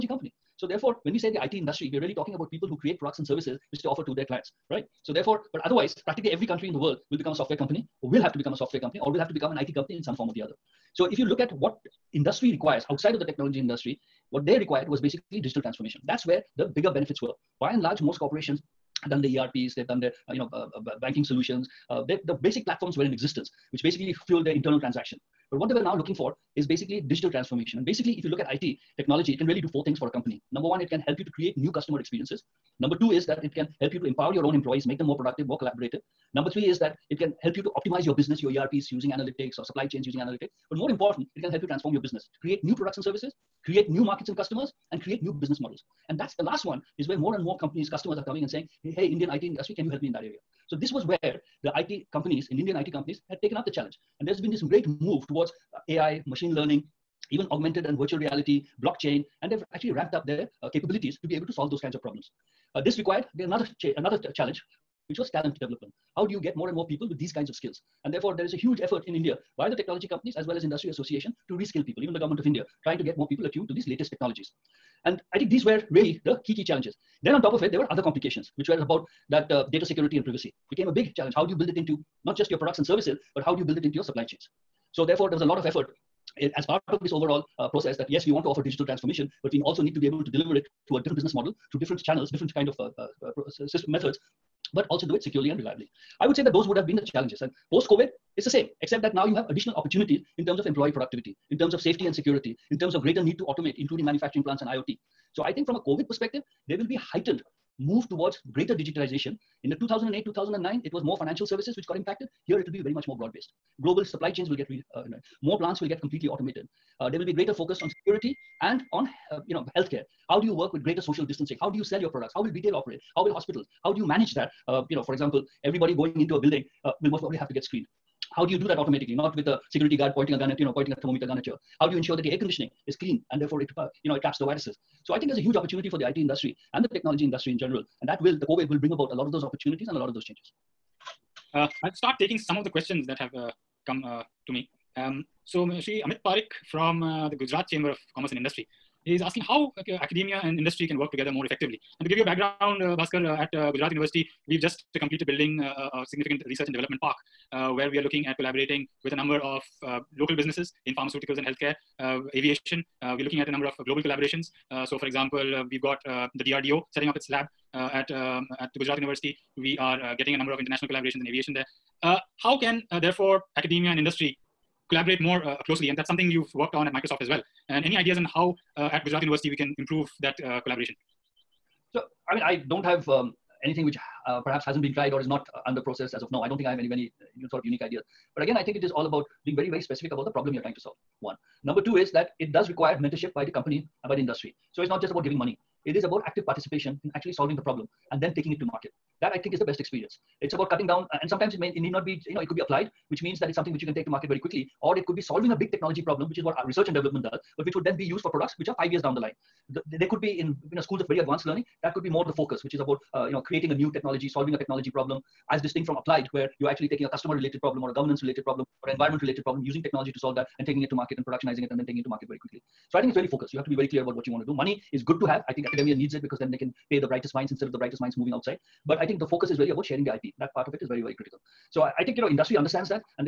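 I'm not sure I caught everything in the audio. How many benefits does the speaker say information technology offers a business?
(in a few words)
4.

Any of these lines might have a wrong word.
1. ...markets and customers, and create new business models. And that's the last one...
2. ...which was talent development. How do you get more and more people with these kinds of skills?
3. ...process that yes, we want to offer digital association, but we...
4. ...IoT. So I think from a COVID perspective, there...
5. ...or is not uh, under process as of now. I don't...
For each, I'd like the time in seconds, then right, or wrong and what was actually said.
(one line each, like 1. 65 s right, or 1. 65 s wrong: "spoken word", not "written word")
1. 44 s right
2. 65 s right
3. 87 s wrong: "transformation", not "association"
4. 104 s right
5. 185 s right.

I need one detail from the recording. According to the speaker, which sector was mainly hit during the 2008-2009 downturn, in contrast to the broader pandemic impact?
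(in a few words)
financial services.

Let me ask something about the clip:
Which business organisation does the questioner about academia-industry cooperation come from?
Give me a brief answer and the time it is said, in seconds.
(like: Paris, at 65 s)
Gujarat Chamber of Commerce and Industry, at 147 s.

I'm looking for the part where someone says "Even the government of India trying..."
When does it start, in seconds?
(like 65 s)
72 s.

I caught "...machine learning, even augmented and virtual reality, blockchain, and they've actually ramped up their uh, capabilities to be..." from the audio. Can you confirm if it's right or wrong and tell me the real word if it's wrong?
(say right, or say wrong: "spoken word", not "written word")
right.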